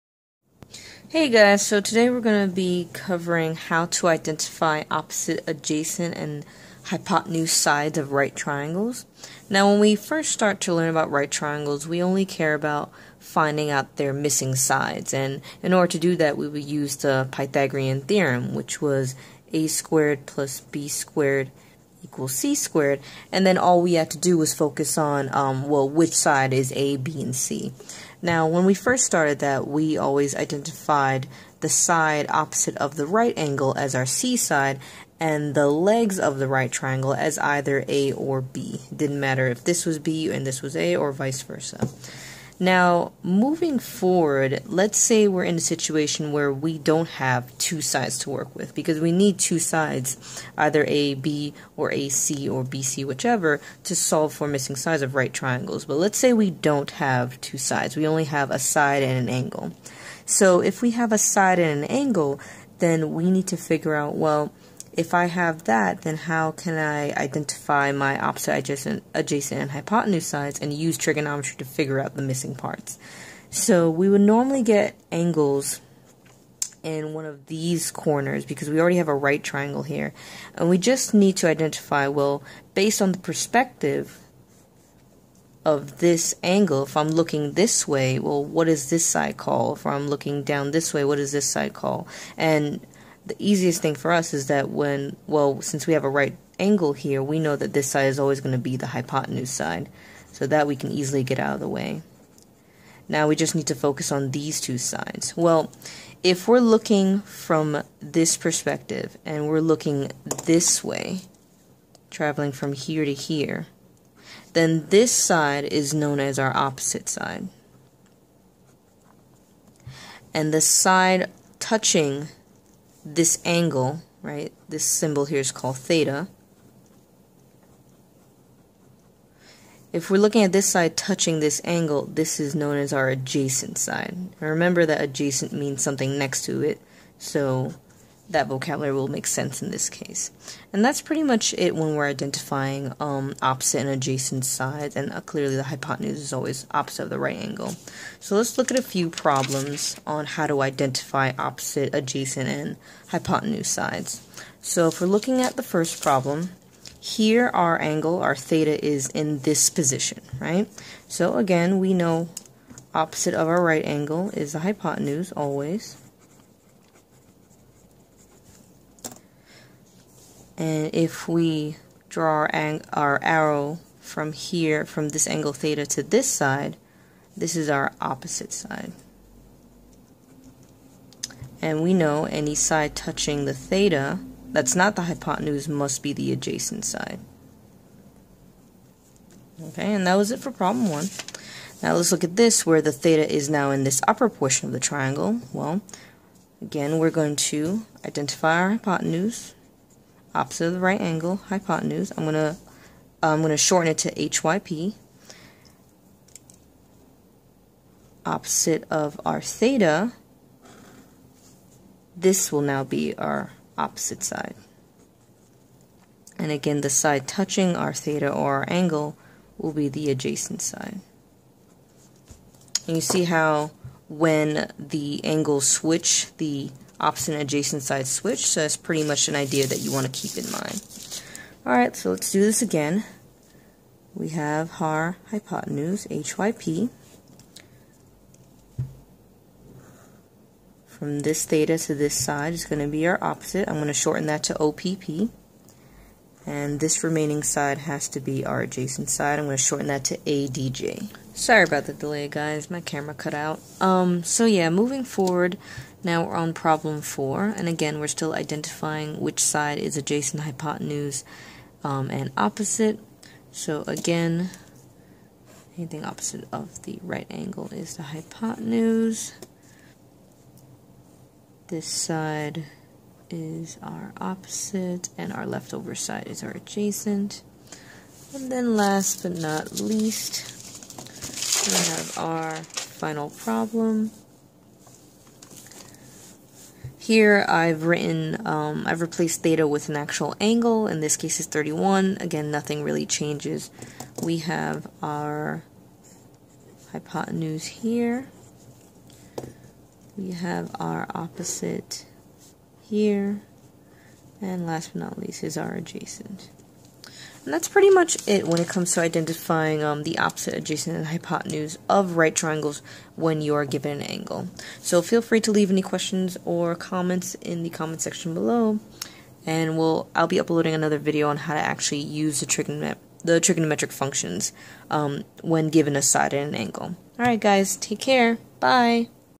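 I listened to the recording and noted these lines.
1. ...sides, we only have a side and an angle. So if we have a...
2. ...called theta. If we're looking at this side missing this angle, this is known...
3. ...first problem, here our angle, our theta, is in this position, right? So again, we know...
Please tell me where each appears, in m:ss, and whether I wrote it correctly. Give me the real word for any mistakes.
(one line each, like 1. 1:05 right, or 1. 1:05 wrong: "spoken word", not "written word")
1. 0:57 right
2. 2:05 wrong: "touching", not "missing"
3. 2:35 right.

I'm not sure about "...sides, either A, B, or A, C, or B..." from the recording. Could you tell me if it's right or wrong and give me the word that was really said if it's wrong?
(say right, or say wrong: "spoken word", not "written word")
right.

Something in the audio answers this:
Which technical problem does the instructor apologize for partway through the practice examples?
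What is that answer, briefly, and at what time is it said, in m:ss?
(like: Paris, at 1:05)
camera cut out, at 4:12.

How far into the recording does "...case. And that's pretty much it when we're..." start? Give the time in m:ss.
2:19.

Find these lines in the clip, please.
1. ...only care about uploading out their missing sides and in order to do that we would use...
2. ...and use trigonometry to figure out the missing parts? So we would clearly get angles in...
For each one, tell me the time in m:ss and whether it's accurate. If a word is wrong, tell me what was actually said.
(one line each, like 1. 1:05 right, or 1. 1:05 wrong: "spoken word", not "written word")
1. 0:12 wrong: "finding", not "uploading"
2. 1:10 wrong: "normally", not "clearly".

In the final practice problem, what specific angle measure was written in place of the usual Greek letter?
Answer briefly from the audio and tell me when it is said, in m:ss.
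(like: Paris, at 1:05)
31, at 4:51.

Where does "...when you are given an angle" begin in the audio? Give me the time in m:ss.
5:13.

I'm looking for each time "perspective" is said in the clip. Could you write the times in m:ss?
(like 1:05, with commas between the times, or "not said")
1:23, 1:48.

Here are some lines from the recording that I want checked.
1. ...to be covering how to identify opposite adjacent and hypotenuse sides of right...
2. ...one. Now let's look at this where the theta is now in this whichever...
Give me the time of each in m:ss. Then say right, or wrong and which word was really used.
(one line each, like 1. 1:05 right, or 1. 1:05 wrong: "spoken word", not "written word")
1. 0:02 right
2. 3:10 wrong: "upper", not "whichever".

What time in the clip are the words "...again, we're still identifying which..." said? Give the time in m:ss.
4:17.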